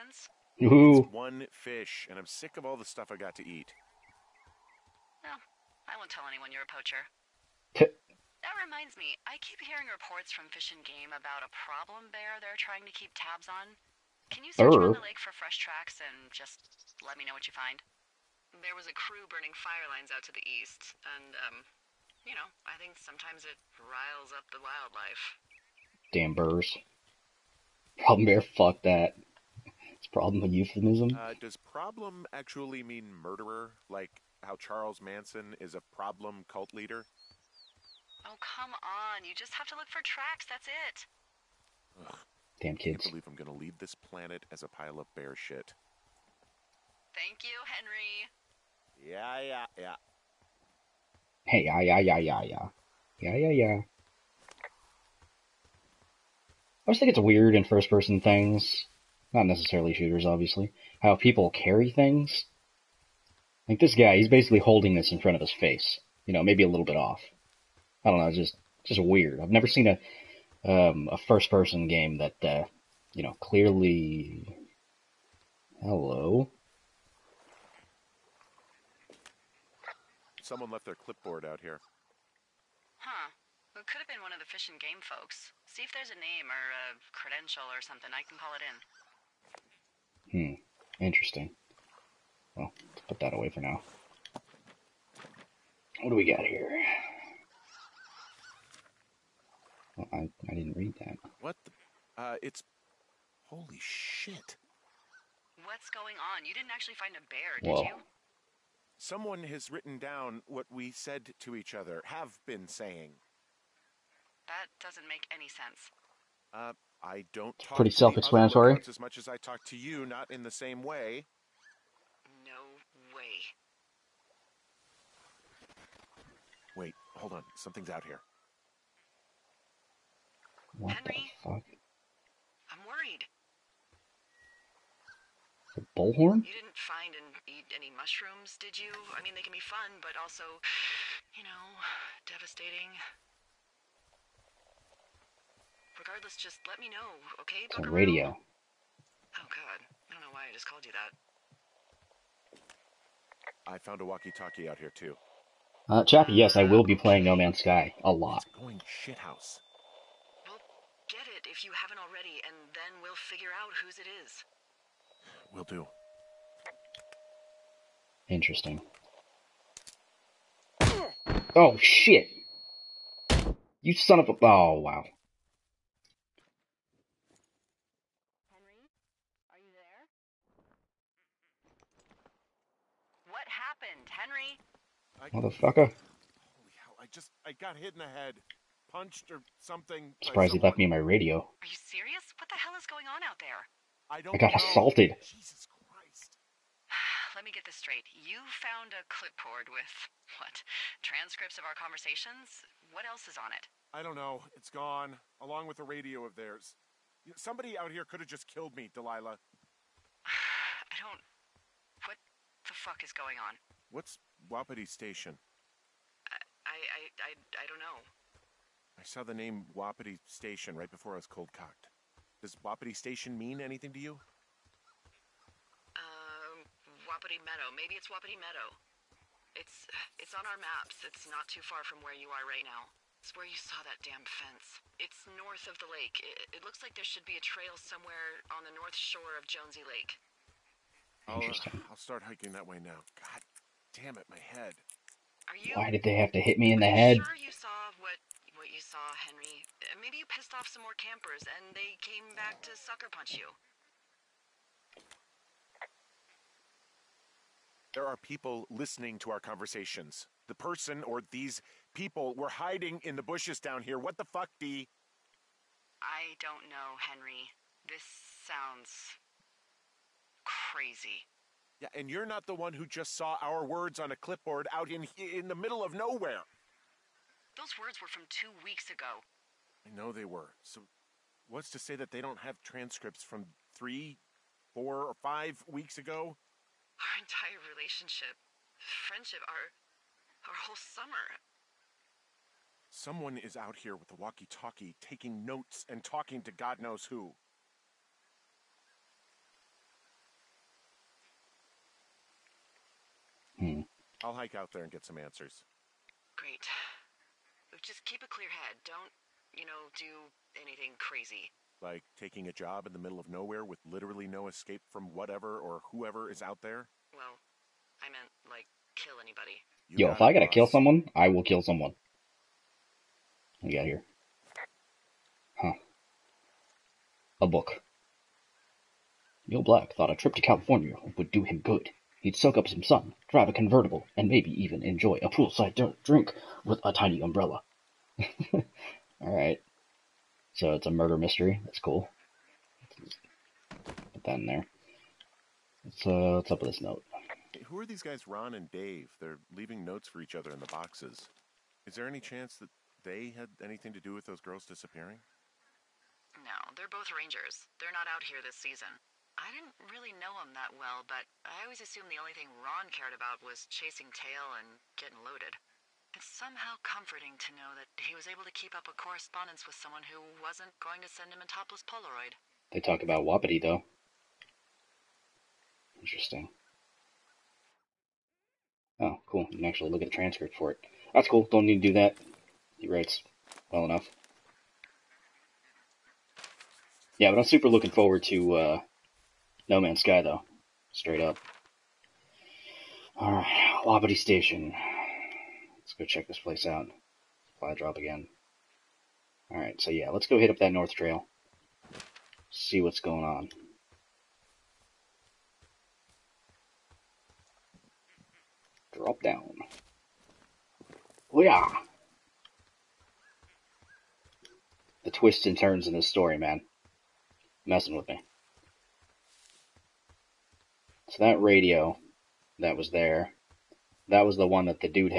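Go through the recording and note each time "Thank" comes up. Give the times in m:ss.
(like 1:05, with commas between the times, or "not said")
0:47.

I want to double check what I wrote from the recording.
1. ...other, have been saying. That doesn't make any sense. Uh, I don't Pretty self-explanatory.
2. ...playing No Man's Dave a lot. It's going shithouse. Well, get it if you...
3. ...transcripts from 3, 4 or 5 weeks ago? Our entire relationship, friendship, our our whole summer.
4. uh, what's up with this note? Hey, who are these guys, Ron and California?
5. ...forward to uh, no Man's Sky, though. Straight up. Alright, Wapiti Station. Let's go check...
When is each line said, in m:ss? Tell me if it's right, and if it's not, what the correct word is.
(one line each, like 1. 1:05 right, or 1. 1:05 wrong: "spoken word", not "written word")
1. 1:51 right
2. 2:36 wrong: "Sky", not "Dave"
3. 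4:42 right
4. 5:46 wrong: "Dave", not "California"
5. 6:27 right.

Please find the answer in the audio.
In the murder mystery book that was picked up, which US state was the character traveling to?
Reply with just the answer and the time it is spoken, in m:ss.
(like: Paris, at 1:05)
California, at 5:30.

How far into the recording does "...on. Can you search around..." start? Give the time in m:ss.
0:13.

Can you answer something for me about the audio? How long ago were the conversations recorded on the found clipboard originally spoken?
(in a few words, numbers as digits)
2 weeks ago.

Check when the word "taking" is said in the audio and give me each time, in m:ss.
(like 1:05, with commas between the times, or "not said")
4:55, 5:12.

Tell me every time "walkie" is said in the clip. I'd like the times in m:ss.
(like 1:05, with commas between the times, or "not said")
2:34, 4:54.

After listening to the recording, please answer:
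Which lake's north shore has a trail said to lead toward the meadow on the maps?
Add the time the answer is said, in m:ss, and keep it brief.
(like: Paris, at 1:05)
Jonesy Lake, at 3:59.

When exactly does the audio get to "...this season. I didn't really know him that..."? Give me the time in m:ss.
5:58.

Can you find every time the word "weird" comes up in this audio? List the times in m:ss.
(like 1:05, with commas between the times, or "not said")
0:57, 1:09.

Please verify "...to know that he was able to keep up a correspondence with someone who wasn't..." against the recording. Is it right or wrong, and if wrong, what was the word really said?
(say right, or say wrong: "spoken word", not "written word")
right.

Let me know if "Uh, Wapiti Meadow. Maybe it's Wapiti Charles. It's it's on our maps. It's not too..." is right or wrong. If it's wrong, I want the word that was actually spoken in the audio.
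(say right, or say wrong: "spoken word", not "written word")
wrong: "Meadow", not "Charles".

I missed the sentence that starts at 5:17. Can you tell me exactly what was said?
Well, I meant, like, kill anybody.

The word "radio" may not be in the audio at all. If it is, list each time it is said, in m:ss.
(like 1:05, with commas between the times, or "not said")
2:27, 3:11, 3:25, 7:01.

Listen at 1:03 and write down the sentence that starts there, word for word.
Like this guy, he's basically holding this in front of his face.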